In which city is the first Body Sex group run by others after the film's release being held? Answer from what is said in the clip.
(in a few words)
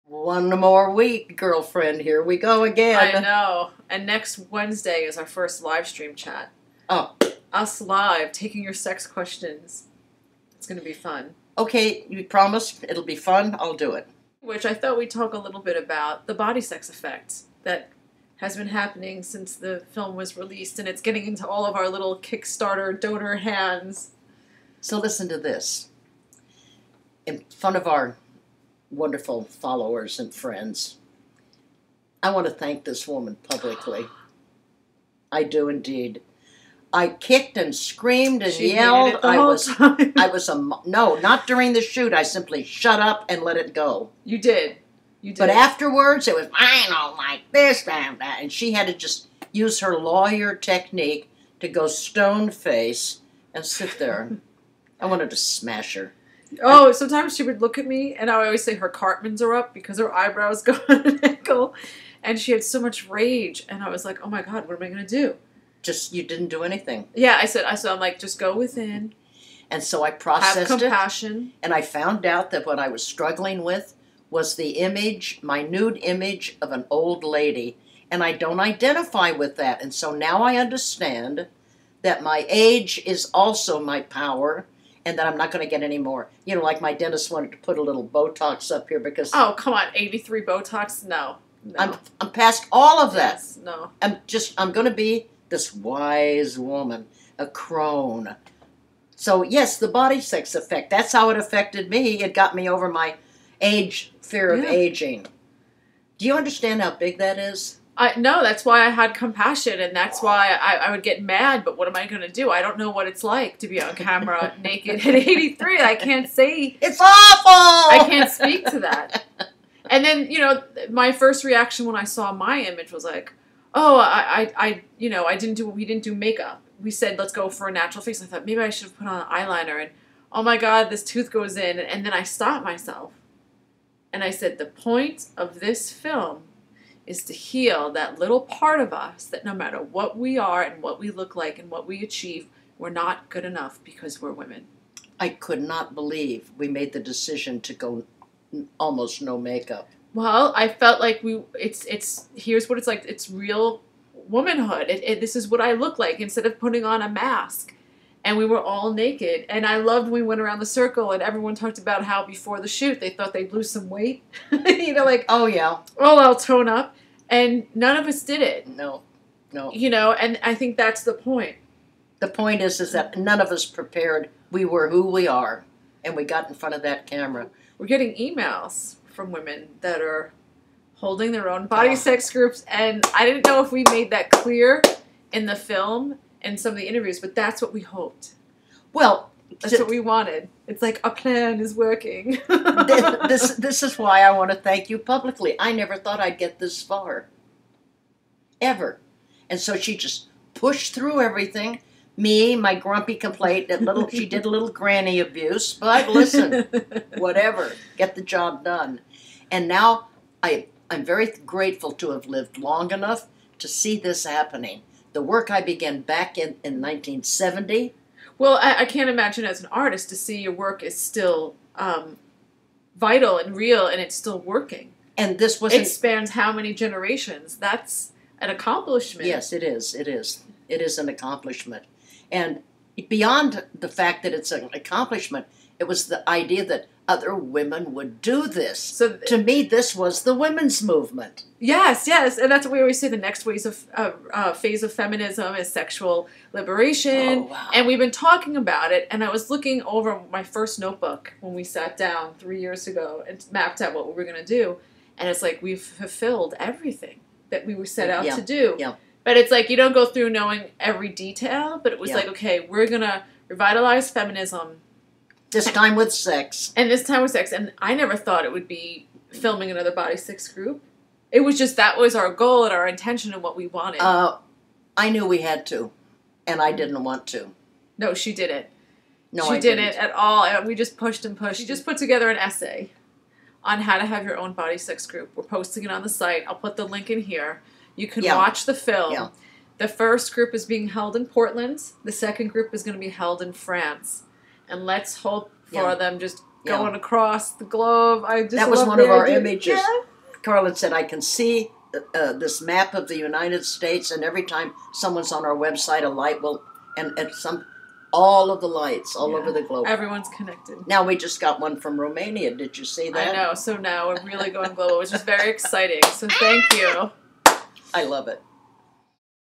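Portland.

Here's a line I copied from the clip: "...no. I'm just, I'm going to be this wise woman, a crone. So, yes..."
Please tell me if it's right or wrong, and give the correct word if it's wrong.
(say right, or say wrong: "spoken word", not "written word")
right.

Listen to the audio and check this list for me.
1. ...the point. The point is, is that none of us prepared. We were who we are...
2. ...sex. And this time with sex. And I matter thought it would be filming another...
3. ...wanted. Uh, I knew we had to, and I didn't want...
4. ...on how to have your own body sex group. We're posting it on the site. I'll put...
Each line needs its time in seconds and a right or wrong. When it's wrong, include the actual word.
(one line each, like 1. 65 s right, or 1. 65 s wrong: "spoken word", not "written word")
1. 171 s right
2. 266 s wrong: "never", not "matter"
3. 273 s right
4. 283 s right.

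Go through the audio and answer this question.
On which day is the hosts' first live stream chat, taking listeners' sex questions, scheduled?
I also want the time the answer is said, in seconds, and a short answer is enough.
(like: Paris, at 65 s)
Wednesday, at 4 s.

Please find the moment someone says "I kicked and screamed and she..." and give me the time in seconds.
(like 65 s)
36 s.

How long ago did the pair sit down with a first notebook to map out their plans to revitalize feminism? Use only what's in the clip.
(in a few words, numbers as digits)
3 years ago.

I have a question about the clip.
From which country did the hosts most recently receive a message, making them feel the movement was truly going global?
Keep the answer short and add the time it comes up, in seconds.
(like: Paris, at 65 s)
Romania, at 311 s.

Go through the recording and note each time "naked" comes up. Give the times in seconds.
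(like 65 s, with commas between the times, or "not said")
114 s, 158 s.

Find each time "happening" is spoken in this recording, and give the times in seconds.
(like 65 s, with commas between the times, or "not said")
18 s, 214 s.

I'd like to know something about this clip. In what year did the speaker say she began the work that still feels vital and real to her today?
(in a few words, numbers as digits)
1970.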